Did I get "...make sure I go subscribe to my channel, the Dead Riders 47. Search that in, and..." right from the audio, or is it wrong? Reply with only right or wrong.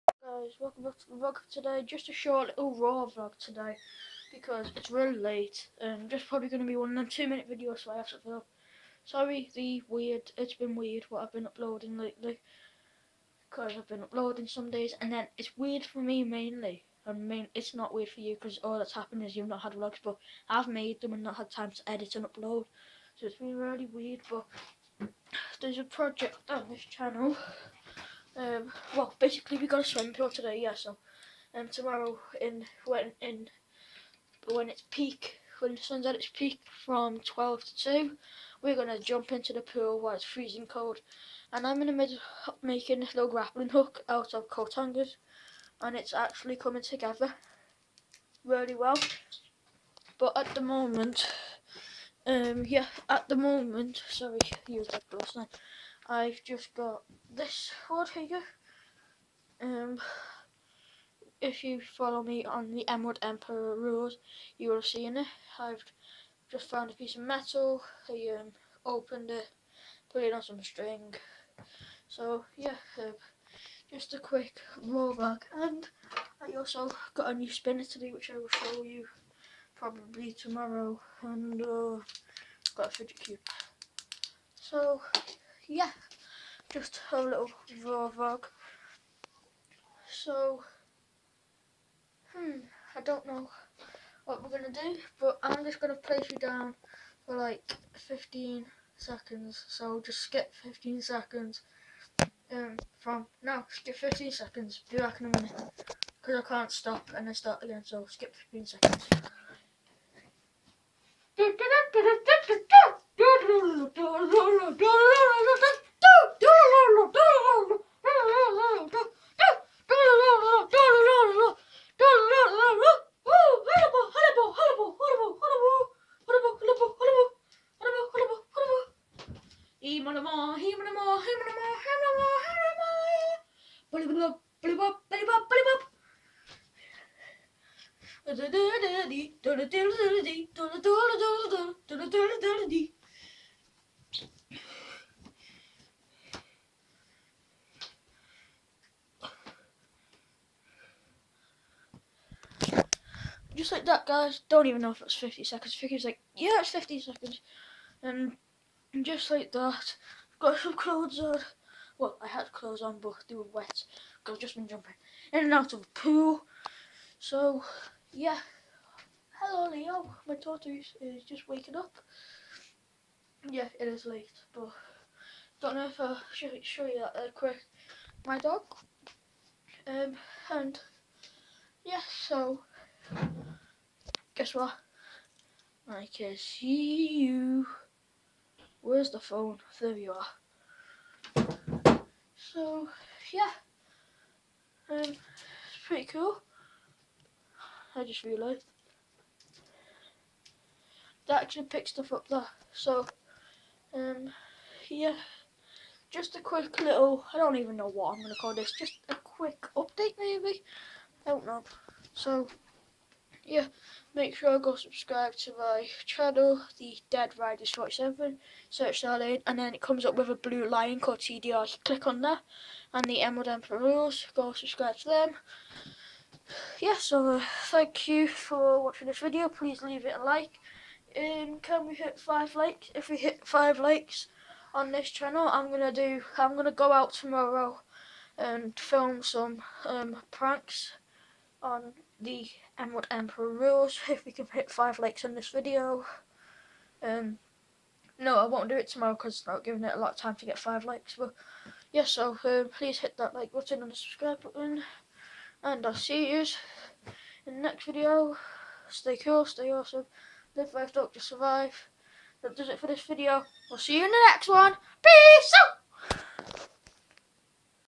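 right.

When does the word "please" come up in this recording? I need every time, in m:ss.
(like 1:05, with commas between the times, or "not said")
3:49, 4:12.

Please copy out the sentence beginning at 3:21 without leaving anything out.
That actually picks stuff up there.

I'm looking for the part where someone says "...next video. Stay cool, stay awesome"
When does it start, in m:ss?
4:17.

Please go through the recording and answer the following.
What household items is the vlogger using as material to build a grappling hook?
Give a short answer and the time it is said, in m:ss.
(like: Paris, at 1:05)
Coat hangers, at 0:44.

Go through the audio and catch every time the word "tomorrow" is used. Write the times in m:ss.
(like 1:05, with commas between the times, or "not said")
0:31, 1:20, 3:57, 4:08.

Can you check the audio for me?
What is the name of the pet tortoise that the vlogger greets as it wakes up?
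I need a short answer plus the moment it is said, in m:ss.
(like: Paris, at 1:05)
Leo, at 2:49.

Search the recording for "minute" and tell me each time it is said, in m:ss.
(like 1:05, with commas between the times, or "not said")
0:07, 1:45.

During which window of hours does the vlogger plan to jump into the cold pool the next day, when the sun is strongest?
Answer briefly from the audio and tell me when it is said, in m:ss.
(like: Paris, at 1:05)
12 to 2, at 0:37.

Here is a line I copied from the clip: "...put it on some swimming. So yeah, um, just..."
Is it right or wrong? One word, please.
wrong.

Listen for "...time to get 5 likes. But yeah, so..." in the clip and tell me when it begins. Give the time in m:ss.
4:10.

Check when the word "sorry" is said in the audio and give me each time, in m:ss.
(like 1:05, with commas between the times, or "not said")
0:09, 0:54.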